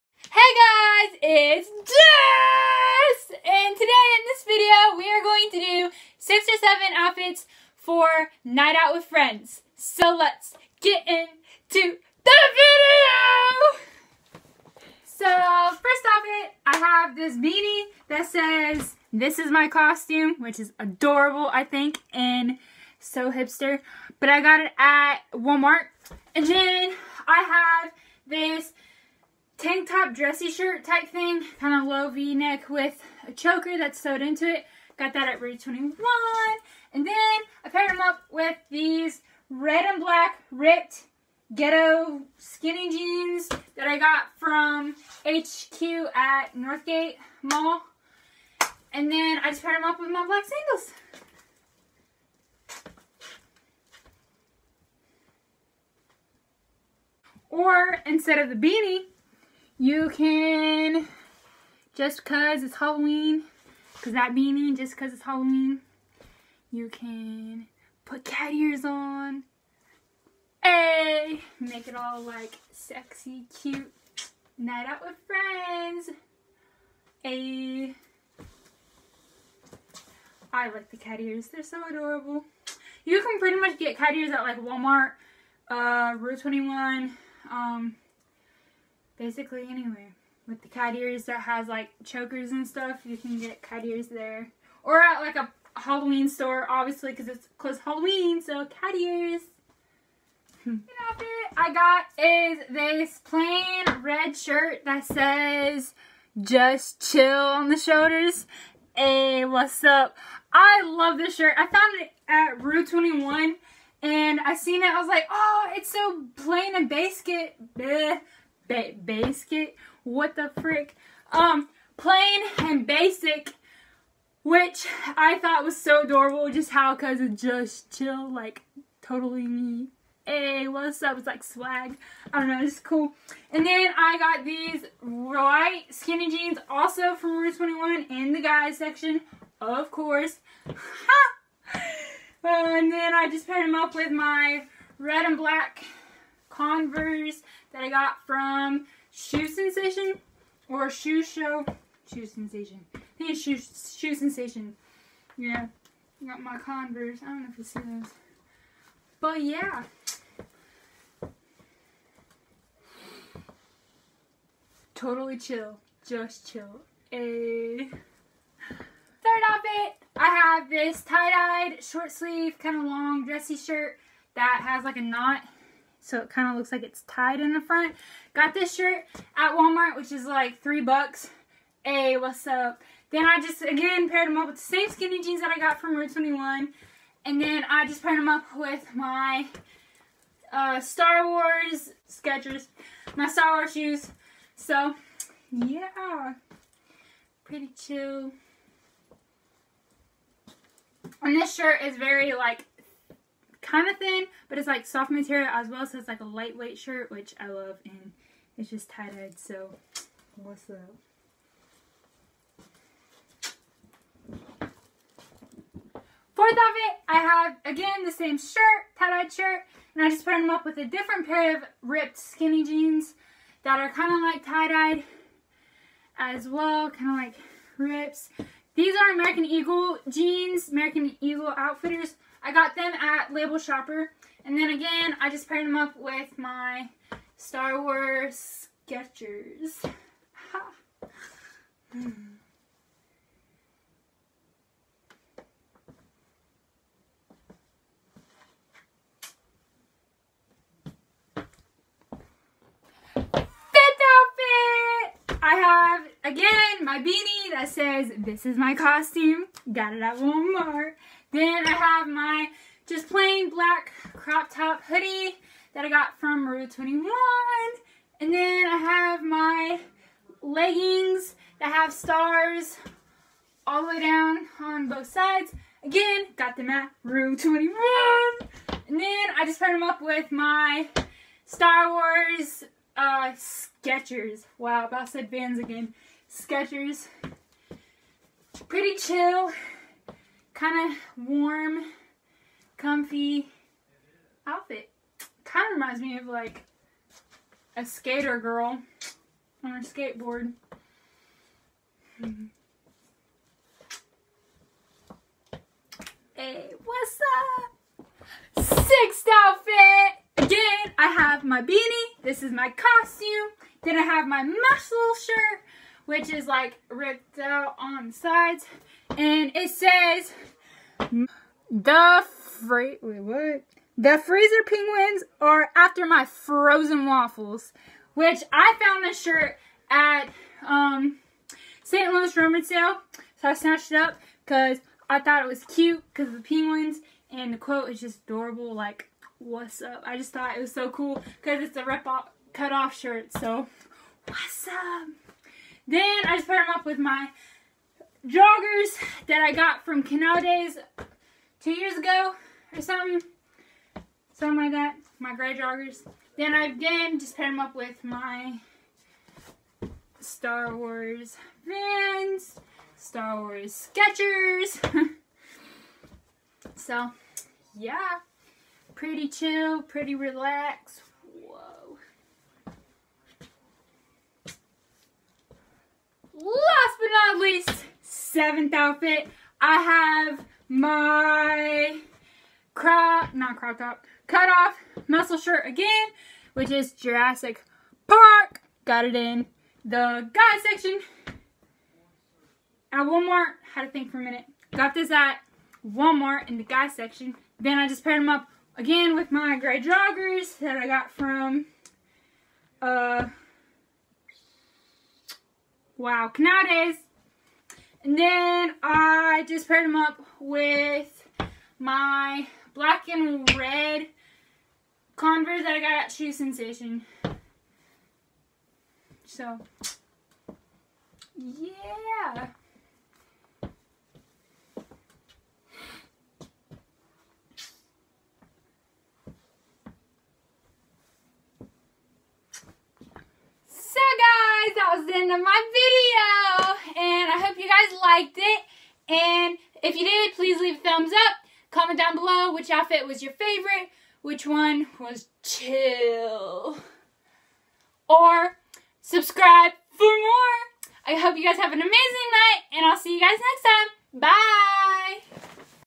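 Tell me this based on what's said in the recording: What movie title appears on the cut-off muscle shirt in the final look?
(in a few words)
Jurassic Park.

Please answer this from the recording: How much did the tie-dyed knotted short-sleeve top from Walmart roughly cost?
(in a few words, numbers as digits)
3 dollars.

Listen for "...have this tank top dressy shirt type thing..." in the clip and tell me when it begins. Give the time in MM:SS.
00:27.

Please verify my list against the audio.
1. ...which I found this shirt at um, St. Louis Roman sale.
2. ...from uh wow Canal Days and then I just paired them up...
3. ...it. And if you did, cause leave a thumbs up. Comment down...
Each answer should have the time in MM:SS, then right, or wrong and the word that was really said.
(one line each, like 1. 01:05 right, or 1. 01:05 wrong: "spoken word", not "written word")
1. 05:28 right
2. 06:41 right
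3. 07:18 wrong: "please", not "cause".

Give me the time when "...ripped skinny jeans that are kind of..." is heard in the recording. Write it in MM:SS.
03:41.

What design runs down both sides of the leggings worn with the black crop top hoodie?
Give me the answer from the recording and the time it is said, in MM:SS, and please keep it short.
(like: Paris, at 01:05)
stars, at 04:31.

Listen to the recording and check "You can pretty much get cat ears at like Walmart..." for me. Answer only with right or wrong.
right.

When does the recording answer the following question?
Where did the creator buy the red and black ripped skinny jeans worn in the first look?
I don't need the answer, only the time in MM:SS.
00:45.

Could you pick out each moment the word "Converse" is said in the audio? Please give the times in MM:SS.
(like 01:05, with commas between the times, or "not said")
02:26, 02:36, 06:55.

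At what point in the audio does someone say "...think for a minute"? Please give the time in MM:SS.
06:33.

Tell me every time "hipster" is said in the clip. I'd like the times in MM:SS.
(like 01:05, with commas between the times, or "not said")
00:23.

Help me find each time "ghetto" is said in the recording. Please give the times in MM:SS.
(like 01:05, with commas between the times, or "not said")
00:41.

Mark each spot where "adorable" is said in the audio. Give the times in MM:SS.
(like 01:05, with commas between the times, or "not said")
00:20, 01:21, 02:06, 05:38.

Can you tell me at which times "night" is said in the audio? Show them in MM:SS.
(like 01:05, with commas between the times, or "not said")
00:08, 01:14, 07:32.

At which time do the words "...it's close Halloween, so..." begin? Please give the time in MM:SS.
01:37.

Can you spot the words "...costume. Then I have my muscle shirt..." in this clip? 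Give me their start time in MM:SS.
05:12.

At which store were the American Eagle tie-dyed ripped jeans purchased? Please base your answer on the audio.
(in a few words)
Label Shopper.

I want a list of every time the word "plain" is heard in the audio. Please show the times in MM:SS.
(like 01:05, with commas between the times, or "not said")
01:43, 01:56, 02:01, 04:23.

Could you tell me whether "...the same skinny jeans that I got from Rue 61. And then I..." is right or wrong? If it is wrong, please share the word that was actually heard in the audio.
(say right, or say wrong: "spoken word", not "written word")
wrong: "21", not "61".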